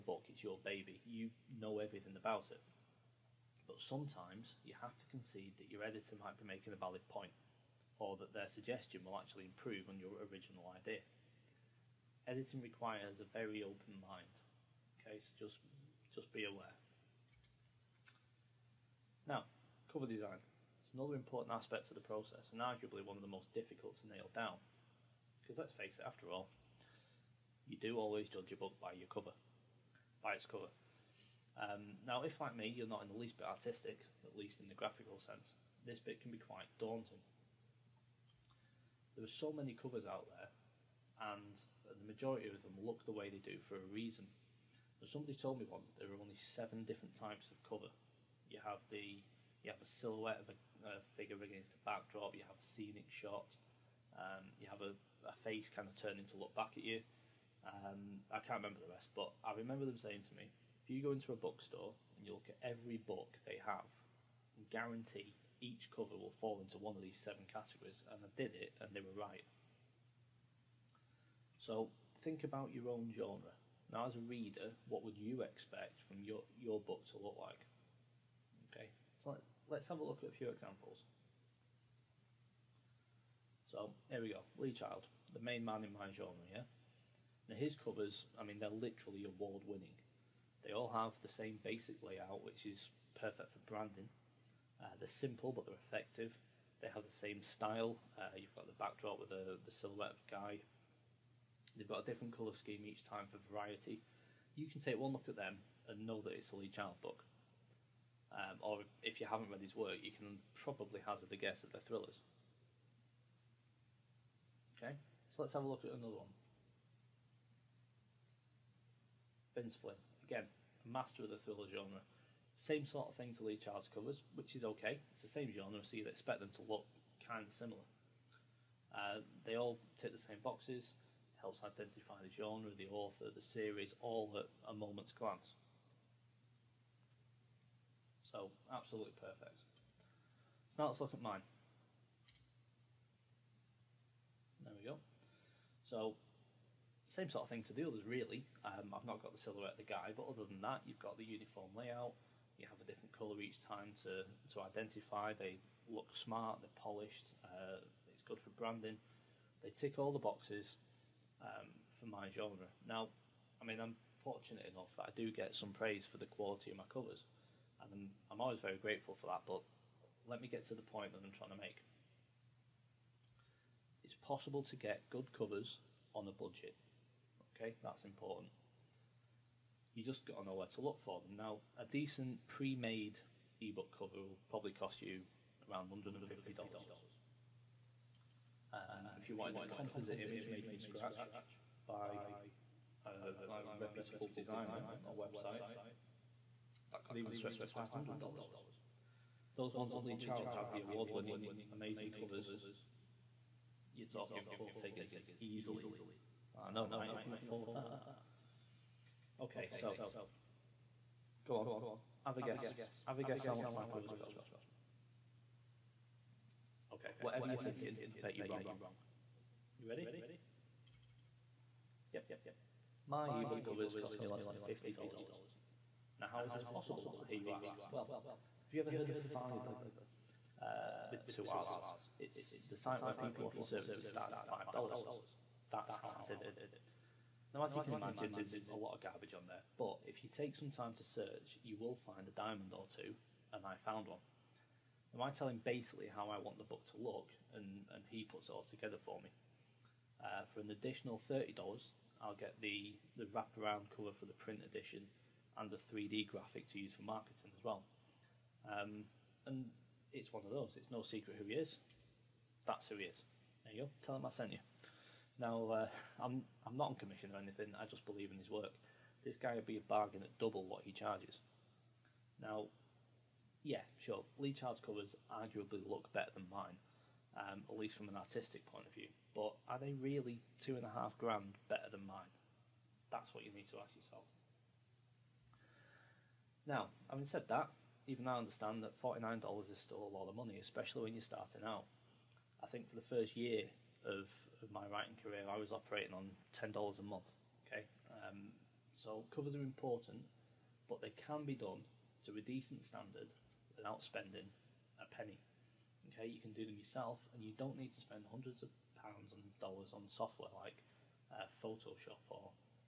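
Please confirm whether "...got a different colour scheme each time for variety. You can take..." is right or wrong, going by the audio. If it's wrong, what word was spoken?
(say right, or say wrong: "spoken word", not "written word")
right.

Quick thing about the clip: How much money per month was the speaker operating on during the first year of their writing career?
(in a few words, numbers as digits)
$10.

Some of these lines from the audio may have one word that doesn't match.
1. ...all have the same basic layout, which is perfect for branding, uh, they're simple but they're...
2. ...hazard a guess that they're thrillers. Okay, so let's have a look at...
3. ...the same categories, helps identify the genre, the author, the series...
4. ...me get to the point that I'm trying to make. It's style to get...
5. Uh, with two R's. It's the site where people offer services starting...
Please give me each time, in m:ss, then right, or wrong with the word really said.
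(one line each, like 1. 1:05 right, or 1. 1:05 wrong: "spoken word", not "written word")
1. 1:30 right
2. 1:51 right
3. 2:10 wrong: "boxes", not "categories"
4. 2:50 wrong: "possible", not "style"
5. 3:50 right.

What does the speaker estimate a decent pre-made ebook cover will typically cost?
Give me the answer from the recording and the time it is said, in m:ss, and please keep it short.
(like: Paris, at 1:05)
$150, at 3:05.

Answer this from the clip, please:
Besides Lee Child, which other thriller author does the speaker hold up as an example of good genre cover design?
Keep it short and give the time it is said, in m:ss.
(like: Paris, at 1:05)
Vince Flynn, at 1:59.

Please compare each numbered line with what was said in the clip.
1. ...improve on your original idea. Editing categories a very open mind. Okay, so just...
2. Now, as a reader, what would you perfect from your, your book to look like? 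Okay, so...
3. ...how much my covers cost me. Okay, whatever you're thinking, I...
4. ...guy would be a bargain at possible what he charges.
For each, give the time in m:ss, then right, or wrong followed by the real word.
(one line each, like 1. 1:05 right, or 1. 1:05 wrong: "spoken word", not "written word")
1. 0:09 wrong: "requires", not "categories"
2. 1:13 wrong: "expect", not "perfect"
3. 3:33 right
4. 4:29 wrong: "double", not "possible".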